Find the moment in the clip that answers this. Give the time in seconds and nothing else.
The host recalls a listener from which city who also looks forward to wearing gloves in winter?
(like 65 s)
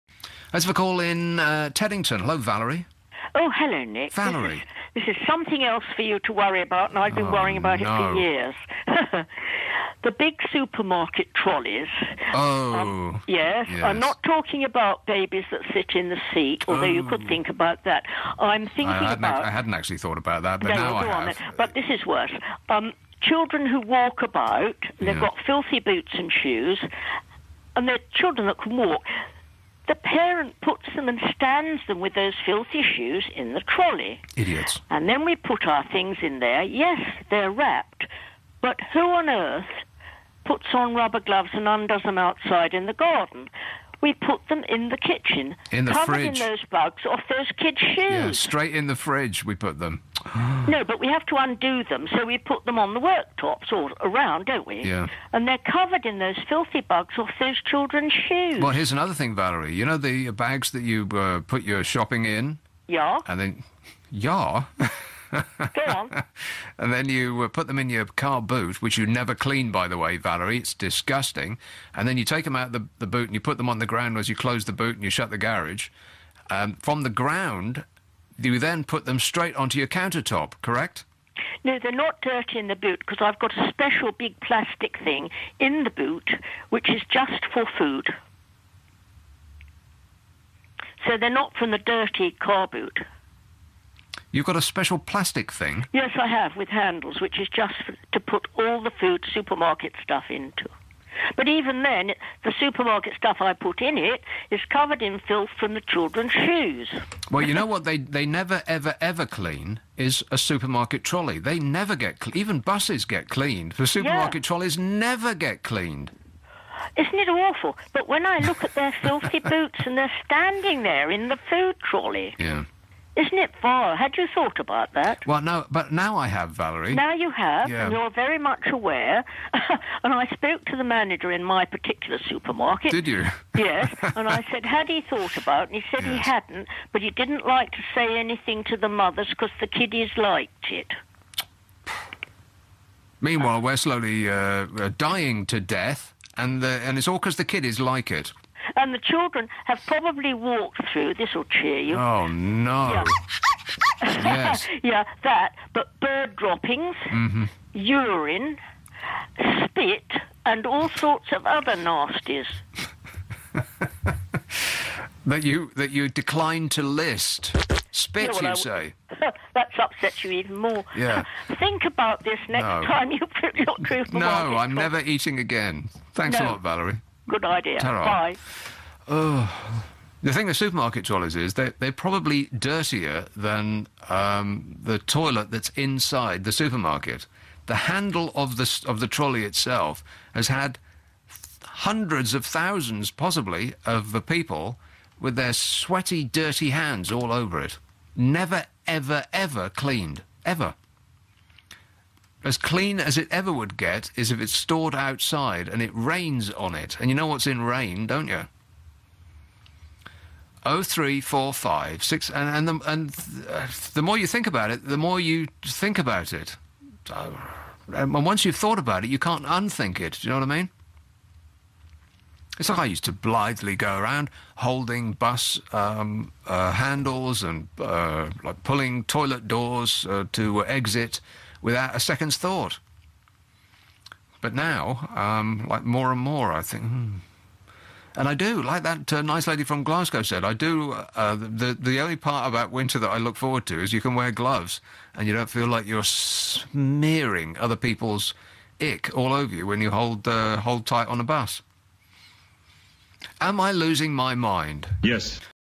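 239 s.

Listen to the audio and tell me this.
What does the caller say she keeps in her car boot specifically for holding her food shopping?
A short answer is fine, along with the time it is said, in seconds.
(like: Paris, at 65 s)
A special big plastic thing, at 83 s.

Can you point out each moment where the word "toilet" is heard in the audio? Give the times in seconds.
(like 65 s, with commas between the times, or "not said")
184 s, 229 s.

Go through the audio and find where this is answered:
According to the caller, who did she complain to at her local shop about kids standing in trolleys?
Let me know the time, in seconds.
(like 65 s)
130 s.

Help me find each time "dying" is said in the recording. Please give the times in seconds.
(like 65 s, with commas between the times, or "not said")
144 s.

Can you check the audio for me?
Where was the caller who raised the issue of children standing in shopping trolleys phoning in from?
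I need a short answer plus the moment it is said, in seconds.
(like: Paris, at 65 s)
Teddington, at 1 s.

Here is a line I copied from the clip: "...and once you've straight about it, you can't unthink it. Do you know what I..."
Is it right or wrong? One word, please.
wrong.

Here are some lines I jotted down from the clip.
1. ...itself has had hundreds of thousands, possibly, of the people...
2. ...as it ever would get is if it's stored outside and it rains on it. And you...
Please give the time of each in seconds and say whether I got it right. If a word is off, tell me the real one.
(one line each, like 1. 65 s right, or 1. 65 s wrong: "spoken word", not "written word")
1. 189 s right
2. 202 s right.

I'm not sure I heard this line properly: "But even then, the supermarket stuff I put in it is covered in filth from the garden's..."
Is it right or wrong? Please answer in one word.
wrong.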